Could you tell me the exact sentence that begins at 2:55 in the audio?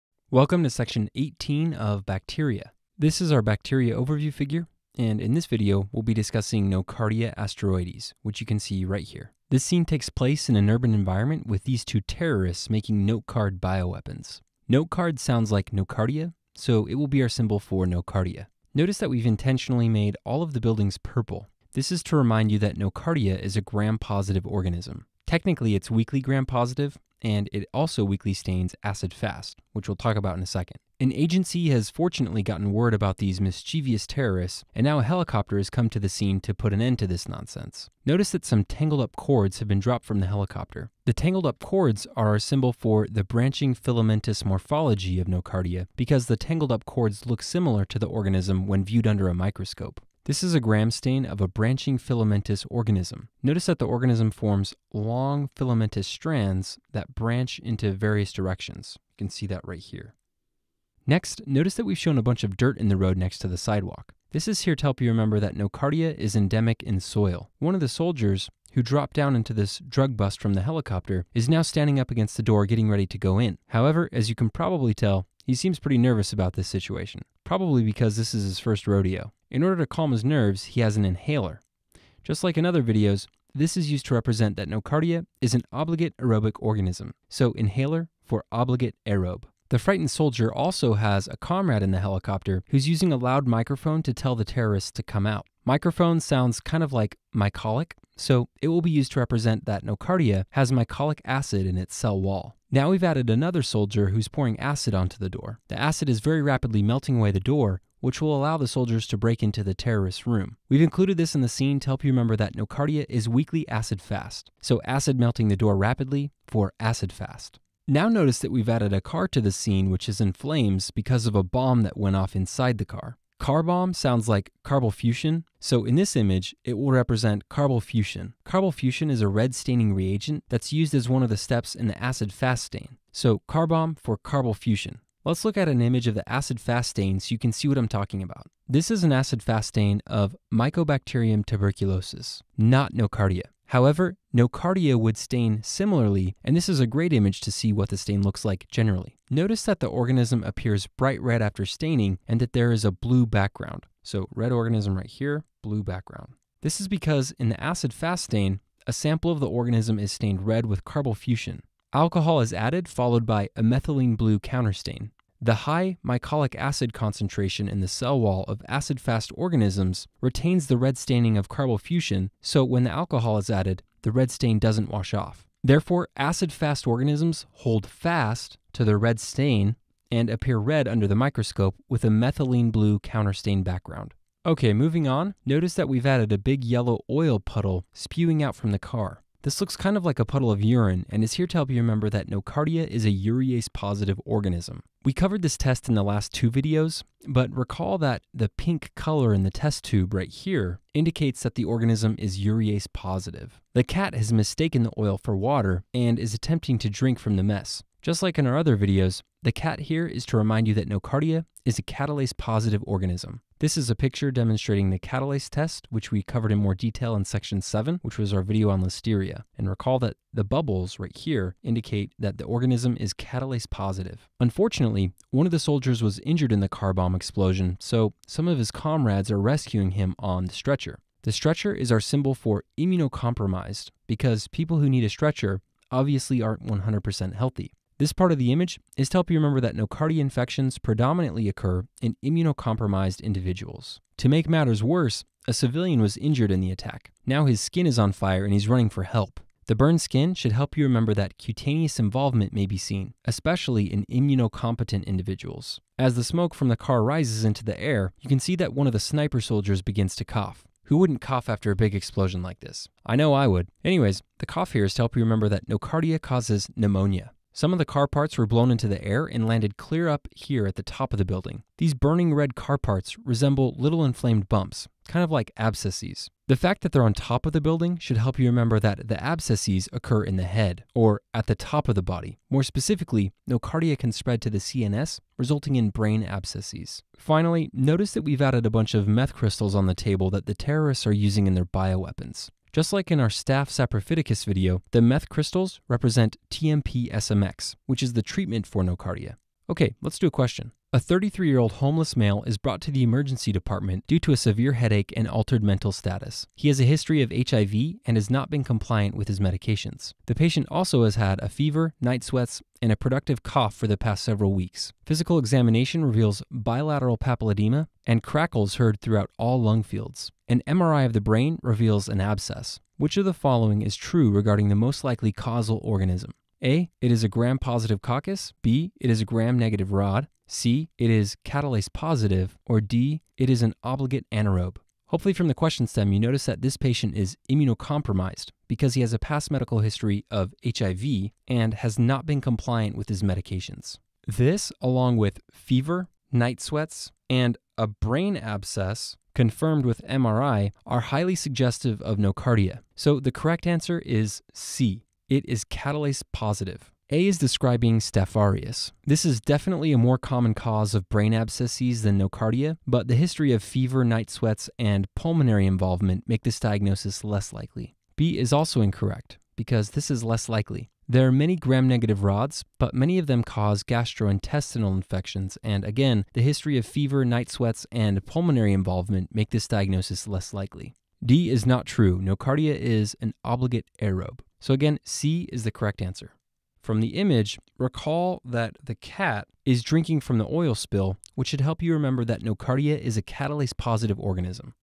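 Therefore, acid-fast organisms hold fast to their red stain and appear red under the microscope with a methylene blue counterstain background.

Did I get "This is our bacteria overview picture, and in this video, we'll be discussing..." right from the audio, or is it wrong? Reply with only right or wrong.
wrong.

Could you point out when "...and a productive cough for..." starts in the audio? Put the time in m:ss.
5:12.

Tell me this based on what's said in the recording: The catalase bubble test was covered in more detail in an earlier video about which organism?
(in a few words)
Listeria.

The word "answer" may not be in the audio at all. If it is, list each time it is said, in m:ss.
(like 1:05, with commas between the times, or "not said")
5:53, 6:26.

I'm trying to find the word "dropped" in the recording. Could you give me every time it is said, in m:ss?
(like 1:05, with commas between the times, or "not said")
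0:39, 1:08.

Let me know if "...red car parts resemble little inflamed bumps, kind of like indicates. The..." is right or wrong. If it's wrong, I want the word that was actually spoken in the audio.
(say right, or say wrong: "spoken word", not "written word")
wrong: "abscesses", not "indicates".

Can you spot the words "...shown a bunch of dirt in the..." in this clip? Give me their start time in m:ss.
1:01.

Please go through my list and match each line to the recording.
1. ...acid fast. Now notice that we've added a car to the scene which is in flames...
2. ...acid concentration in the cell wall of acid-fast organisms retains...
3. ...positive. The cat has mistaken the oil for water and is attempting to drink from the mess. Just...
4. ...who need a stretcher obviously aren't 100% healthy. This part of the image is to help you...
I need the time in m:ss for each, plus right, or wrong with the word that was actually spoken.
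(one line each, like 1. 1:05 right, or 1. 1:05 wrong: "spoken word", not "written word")
1. 1:56 right
2. 2:46 right
3. 3:22 right
4. 3:54 right.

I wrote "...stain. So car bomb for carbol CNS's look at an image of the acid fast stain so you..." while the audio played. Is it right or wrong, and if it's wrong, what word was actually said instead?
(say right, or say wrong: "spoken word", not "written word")
wrong: "Let", not "CNS".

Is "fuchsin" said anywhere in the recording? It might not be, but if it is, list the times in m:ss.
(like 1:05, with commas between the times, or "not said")
2:07, 2:41, 2:51.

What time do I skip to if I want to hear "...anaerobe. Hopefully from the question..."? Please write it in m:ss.
5:34.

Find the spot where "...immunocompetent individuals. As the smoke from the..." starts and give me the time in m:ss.
4:14.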